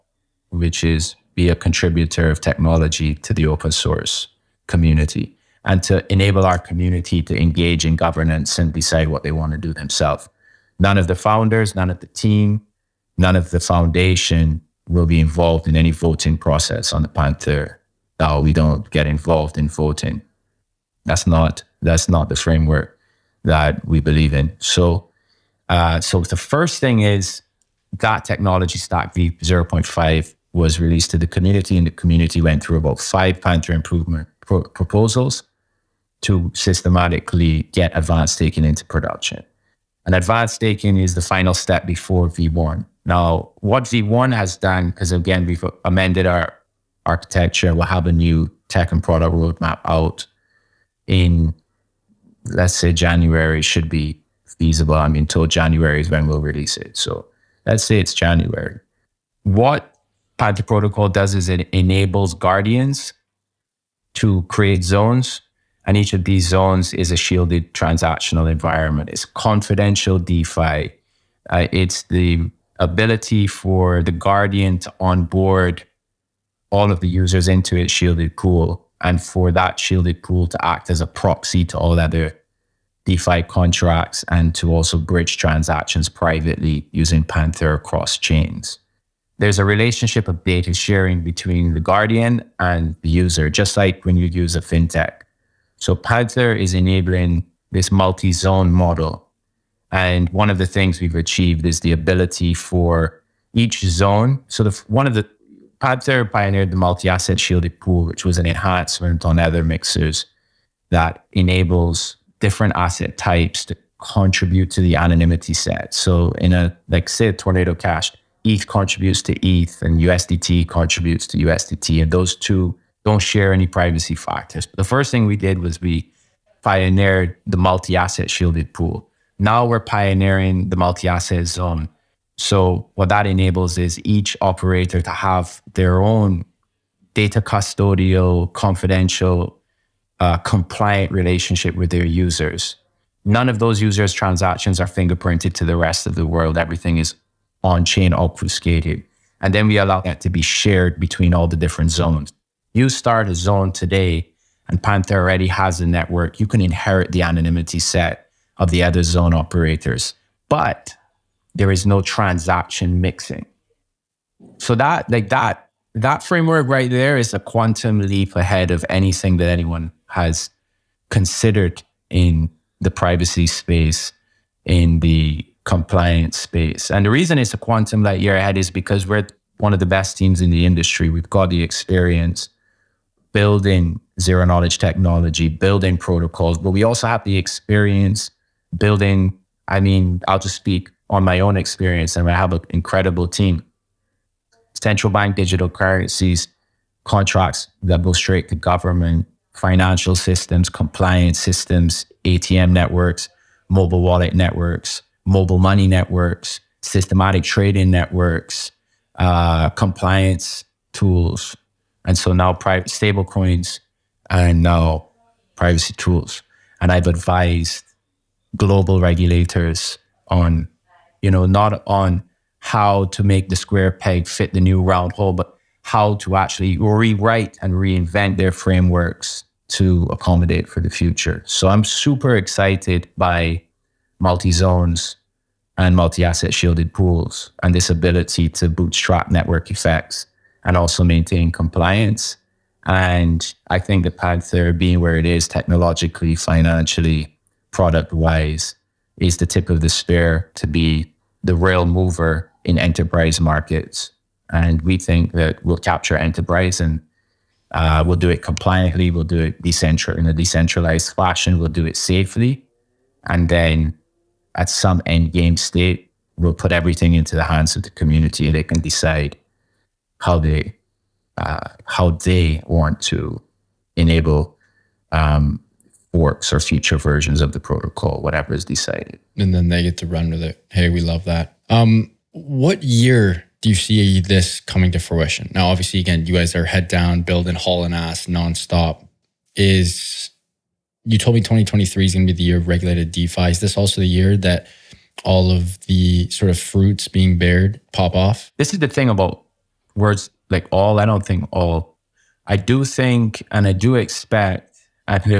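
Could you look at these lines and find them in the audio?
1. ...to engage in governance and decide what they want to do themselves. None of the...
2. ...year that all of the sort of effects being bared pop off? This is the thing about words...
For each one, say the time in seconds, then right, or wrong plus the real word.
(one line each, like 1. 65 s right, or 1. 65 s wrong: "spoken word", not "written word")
1. 7 s right
2. 294 s wrong: "fruits", not "effects".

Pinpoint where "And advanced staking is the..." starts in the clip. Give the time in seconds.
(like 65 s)
40 s.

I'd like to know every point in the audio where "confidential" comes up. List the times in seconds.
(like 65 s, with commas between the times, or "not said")
69 s, 138 s.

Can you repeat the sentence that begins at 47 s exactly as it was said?
We'll have a new tech and product roadmap out in, let's say, January should be feasible.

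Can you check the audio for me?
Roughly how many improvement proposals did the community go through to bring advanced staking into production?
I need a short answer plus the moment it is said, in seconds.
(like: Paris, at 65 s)
5, at 32 s.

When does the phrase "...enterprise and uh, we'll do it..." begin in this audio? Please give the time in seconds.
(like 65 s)
256 s.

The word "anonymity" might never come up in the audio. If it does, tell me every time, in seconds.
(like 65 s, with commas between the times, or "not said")
114 s, 157 s.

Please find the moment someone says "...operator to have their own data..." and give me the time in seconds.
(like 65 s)
134 s.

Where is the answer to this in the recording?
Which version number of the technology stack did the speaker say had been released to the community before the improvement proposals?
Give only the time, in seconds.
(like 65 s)
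29 s.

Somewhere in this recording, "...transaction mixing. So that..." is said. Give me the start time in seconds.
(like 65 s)
162 s.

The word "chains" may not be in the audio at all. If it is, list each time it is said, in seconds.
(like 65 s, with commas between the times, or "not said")
88 s, 147 s.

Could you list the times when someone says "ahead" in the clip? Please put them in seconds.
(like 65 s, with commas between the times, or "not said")
168 s, 178 s.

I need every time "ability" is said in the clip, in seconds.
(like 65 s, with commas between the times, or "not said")
72 s, 101 s, 237 s.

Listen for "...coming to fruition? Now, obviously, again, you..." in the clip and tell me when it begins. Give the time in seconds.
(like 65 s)
284 s.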